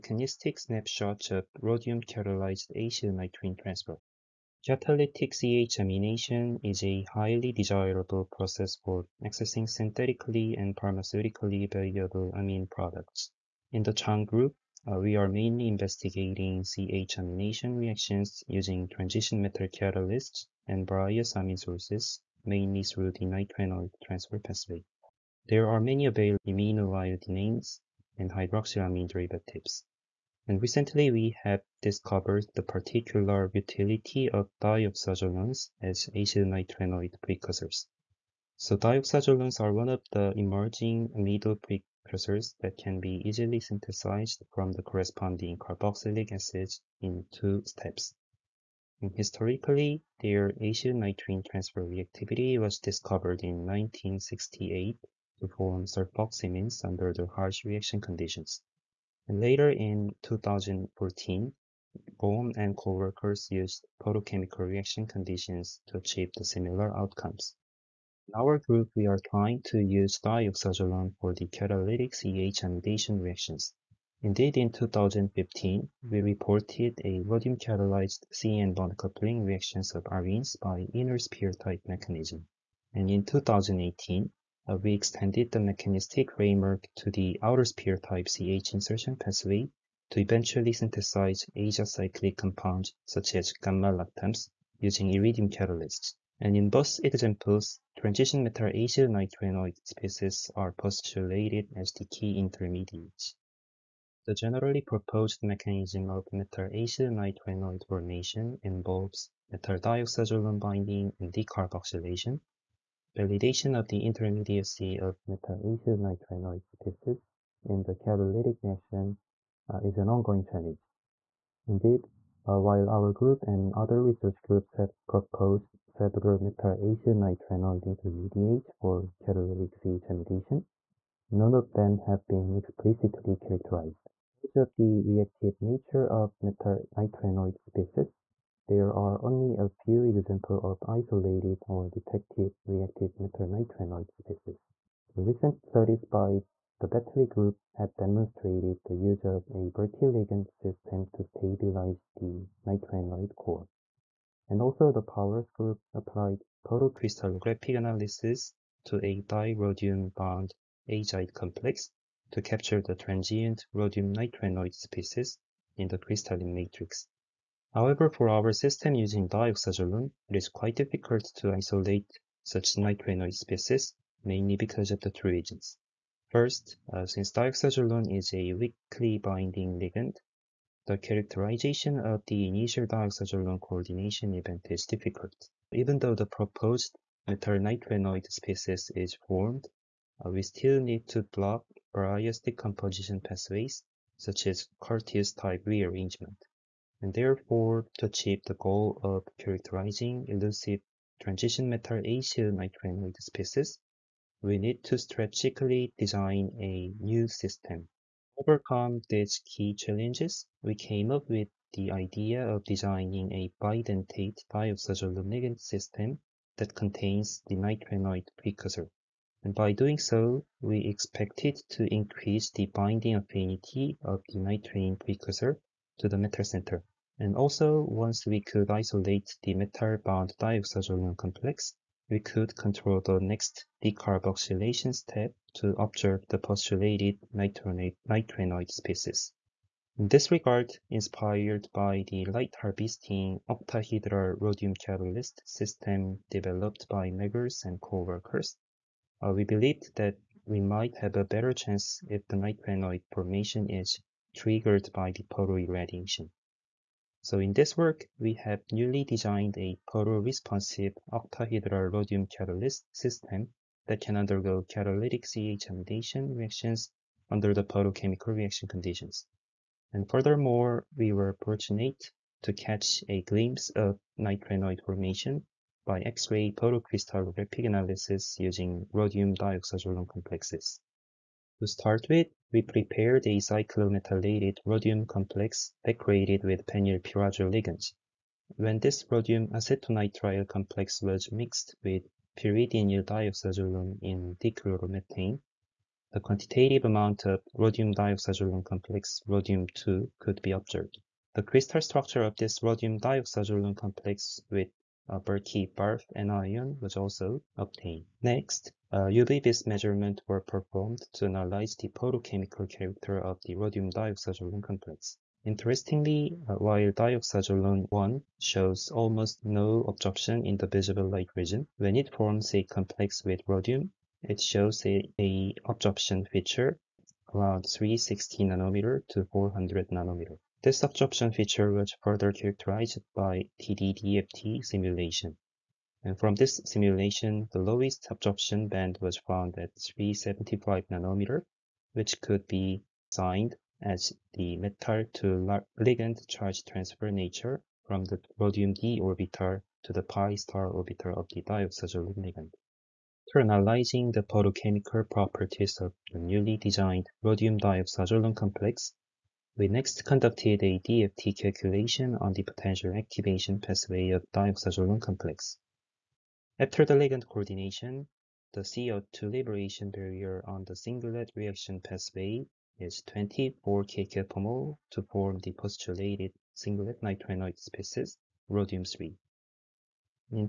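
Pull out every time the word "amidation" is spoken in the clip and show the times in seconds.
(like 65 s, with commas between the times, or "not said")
72 s, 265 s.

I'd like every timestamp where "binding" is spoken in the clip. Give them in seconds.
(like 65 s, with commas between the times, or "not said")
110 s, 179 s, 222 s.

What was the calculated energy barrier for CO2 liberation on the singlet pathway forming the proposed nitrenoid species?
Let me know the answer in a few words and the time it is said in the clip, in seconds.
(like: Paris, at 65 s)
24 kcal/mol, at 373 s.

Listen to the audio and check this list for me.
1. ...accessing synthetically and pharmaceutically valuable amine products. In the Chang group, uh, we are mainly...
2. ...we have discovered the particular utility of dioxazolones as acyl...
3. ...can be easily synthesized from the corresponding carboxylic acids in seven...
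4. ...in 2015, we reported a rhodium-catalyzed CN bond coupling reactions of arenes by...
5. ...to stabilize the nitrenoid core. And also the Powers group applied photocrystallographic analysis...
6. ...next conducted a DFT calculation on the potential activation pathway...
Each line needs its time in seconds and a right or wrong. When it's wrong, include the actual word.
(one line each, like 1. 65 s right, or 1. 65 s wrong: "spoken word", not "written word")
1. 9 s right
2. 31 s right
3. 42 s wrong: "two", not "seven"
4. 74 s right
5. 151 s right
6. 359 s right.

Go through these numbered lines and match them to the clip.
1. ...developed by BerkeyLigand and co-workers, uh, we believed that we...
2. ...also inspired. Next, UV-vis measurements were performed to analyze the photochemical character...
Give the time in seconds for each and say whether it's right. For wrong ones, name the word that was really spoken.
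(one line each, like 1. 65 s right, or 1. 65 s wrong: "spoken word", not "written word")
1. 246 s wrong: "Meggers", not "BerkeyLigand"
2. 306 s wrong: "obtained", not "inspired".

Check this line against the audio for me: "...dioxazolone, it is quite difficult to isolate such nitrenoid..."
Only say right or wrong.
right.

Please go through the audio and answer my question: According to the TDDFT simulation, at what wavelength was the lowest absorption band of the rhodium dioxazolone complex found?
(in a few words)
375 nm.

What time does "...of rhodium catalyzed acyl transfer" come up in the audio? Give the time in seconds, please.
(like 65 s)
1 s.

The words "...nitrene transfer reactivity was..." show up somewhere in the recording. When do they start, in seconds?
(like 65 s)
50 s.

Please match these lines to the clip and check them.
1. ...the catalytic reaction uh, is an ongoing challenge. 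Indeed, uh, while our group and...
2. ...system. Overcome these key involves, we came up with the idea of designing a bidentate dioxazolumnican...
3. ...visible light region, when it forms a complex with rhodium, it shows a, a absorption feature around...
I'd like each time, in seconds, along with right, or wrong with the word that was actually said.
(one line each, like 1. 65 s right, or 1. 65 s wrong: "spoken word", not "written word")
1. 117 s right
2. 207 s wrong: "challenges", not "involves"
3. 320 s right.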